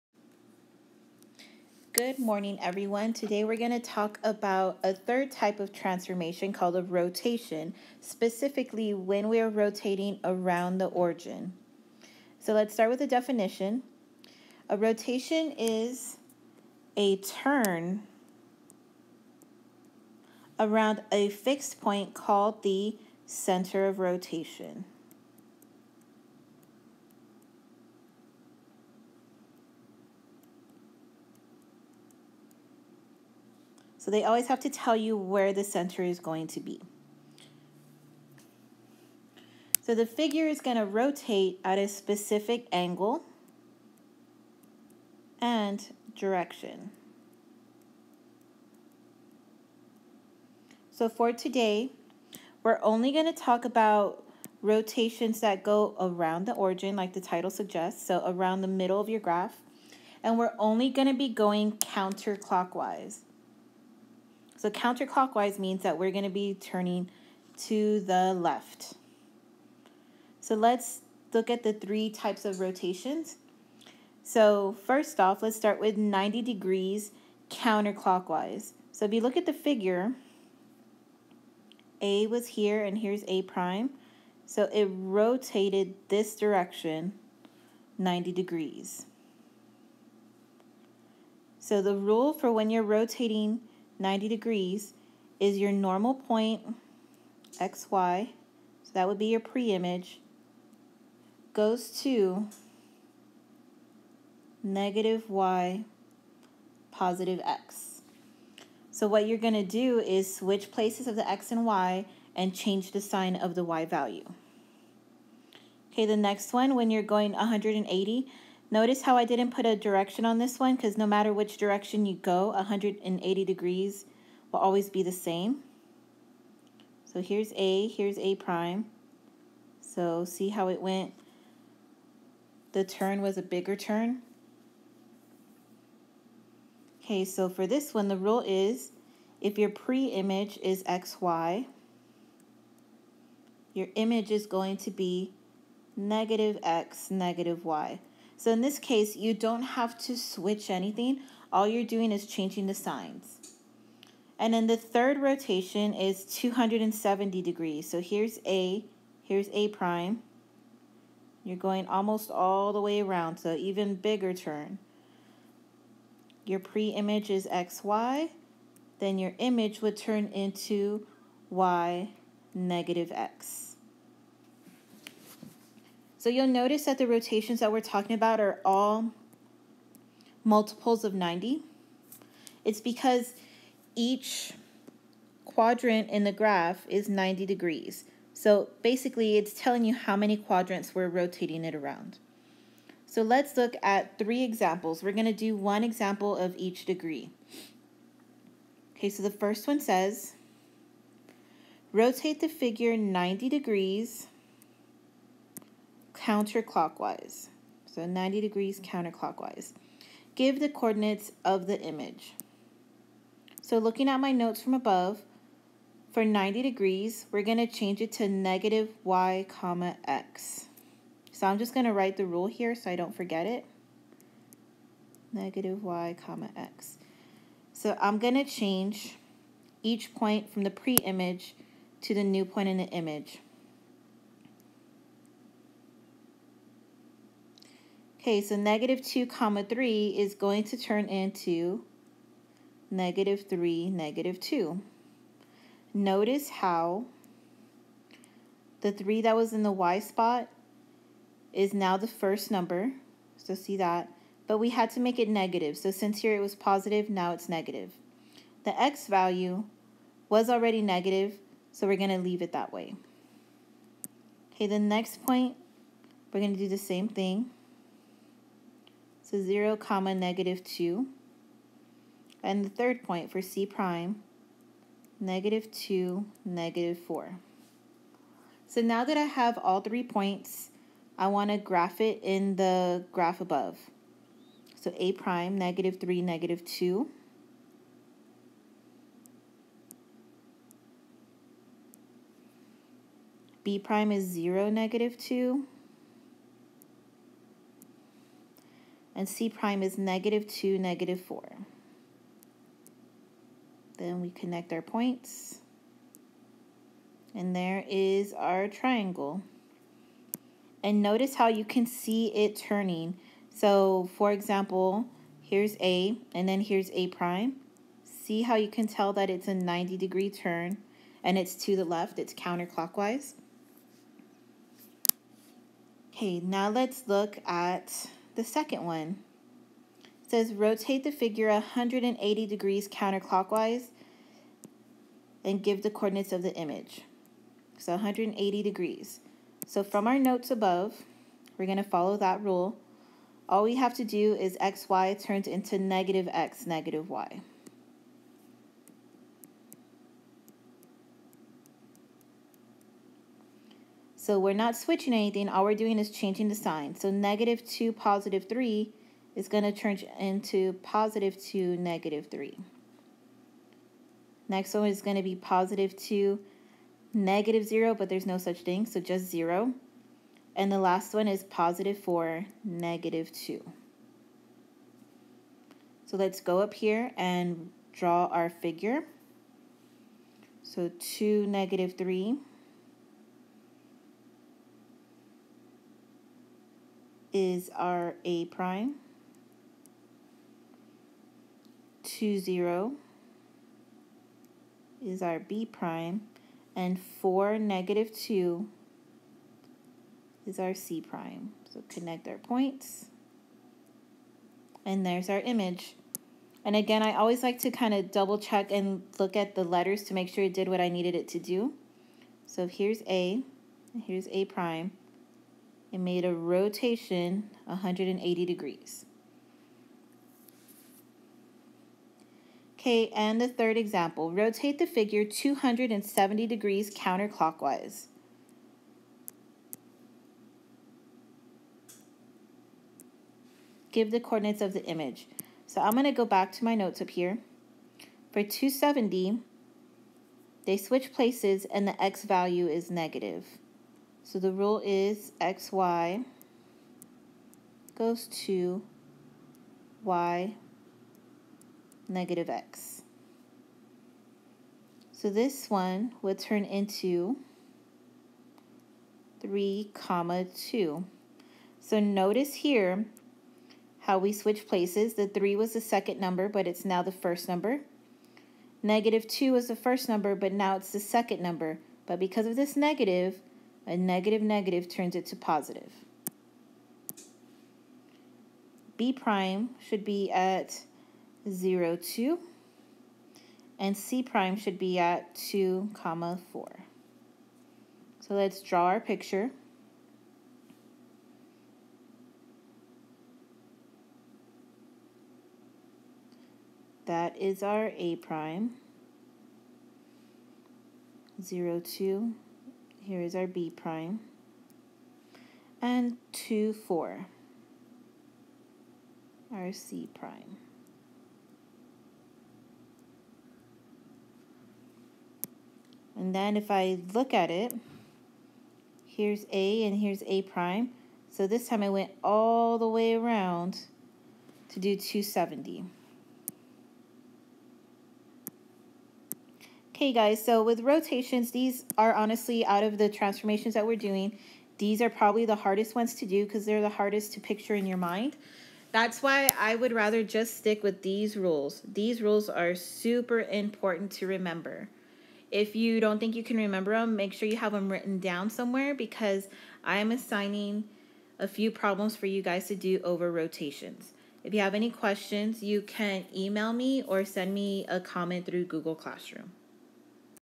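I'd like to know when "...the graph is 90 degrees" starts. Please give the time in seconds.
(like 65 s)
186 s.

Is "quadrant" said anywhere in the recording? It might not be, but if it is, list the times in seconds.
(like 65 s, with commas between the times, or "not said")
185 s, 190 s.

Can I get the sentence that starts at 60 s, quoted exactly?
And we're only going to be going counterclockwise.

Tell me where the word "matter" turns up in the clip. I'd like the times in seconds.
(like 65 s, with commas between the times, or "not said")
121 s.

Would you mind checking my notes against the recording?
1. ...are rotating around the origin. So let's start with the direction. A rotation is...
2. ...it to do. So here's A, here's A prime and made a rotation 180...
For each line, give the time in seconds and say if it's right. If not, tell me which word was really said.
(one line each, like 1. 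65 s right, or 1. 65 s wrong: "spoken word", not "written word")
1. 9 s wrong: "definition", not "direction"
2. 411 s right.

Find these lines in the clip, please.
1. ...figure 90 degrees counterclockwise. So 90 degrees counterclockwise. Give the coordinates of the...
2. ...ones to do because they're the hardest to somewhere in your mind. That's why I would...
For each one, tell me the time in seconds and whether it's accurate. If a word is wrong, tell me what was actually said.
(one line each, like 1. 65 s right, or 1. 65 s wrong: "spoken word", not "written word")
1. 202 s right
2. 535 s wrong: "picture", not "somewhere".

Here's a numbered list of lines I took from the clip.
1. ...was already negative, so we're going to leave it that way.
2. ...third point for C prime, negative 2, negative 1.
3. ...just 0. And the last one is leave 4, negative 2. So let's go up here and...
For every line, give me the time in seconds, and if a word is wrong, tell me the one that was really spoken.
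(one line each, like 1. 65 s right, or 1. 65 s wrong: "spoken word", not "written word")
1. 260 s right
2. 272 s wrong: "4", not "1"
3. 368 s wrong: "positive", not "leave".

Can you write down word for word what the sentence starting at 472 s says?
But because of this negative, a negative negative turns it to positive.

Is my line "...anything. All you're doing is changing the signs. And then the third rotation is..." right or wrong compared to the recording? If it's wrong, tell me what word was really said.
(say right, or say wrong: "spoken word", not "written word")
right.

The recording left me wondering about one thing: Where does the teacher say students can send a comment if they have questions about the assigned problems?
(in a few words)
Google Classroom.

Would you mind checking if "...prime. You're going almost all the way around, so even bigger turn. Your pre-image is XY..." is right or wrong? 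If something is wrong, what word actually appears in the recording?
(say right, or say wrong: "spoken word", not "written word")
right.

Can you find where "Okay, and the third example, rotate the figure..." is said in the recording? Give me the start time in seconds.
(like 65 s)
422 s.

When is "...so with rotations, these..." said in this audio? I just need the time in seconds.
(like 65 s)
530 s.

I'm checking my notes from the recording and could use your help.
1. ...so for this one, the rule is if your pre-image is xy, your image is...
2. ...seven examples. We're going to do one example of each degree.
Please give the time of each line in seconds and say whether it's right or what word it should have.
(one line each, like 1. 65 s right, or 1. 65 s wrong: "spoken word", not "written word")
1. 137 s right
2. 194 s wrong: "three", not "seven".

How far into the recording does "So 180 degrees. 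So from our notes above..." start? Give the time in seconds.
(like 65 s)
337 s.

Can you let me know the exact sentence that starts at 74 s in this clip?
So first off, let's start with 90 degrees counterclockwise.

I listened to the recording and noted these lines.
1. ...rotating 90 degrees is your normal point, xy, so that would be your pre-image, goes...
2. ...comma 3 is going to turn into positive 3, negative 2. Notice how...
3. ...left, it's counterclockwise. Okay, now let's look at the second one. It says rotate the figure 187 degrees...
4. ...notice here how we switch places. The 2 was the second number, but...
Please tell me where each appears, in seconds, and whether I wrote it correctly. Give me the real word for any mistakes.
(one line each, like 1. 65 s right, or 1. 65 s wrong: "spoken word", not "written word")
1. 92 s right
2. 239 s wrong: "negative", not "positive"
3. 321 s wrong: "180", not "187"
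4. 461 s wrong: "3", not "2".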